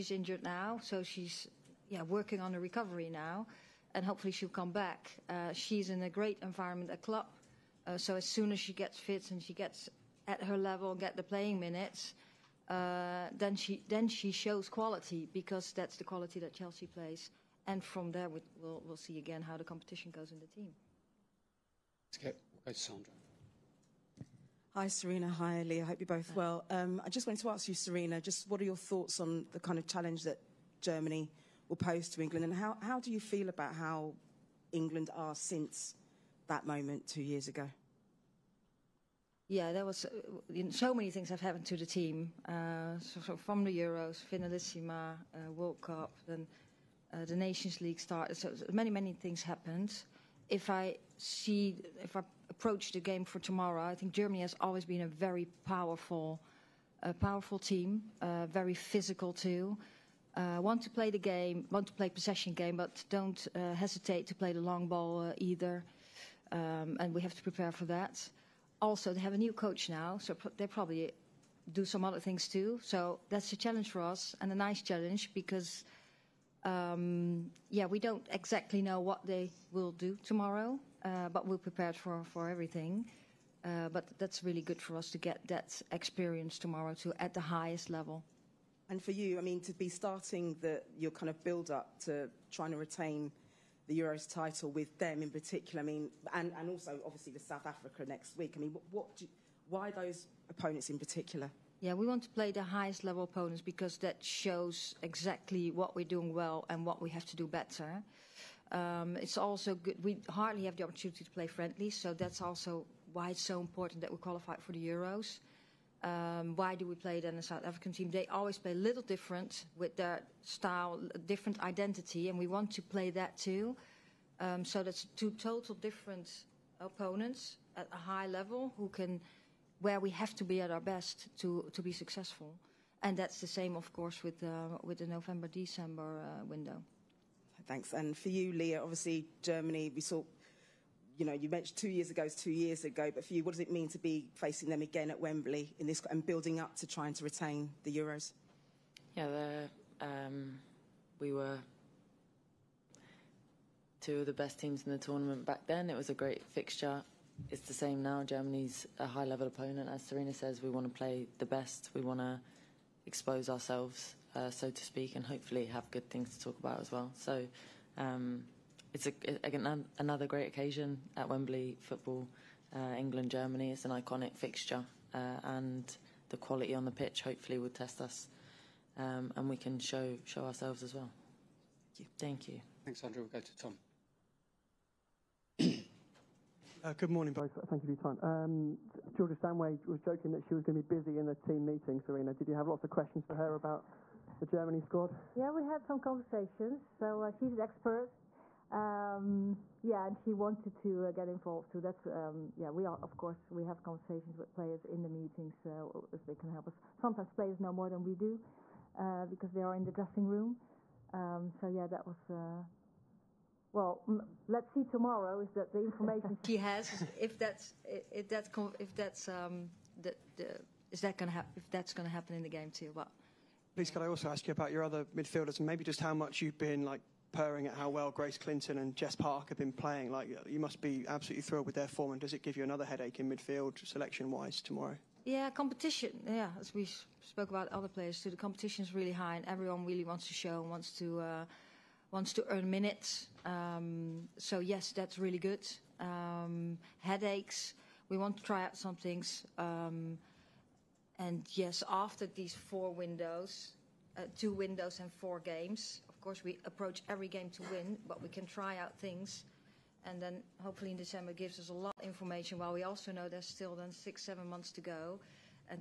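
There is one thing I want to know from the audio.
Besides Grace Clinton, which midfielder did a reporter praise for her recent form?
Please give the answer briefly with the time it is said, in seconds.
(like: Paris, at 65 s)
Jess Park, at 228 s.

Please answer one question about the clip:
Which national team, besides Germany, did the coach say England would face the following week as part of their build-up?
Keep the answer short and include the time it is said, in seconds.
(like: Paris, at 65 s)
South Africa, at 97 s.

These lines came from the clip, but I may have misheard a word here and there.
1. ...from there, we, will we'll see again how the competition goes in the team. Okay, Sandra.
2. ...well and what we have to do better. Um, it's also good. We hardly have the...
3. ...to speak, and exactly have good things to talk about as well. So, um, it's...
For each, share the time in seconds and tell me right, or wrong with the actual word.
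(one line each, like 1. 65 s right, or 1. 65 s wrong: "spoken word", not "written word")
1. 17 s right
2. 106 s right
3. 164 s wrong: "hopefully", not "exactly".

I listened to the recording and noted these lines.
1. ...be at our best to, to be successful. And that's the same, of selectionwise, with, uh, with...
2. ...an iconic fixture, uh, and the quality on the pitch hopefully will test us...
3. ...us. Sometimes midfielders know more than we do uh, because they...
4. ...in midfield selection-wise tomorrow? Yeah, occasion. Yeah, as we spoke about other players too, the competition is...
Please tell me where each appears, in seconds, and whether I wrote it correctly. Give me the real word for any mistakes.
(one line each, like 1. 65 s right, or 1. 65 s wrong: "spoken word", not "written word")
1. 130 s wrong: "course", not "selectionwise"
2. 173 s right
3. 206 s wrong: "players", not "midfielders"
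4. 233 s wrong: "competition", not "occasion".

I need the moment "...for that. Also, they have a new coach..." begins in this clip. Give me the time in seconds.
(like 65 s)
67 s.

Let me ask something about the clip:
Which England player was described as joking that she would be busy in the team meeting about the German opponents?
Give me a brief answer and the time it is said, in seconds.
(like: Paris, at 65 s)
Georgia Stanway, at 189 s.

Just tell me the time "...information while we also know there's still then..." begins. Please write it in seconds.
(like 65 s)
262 s.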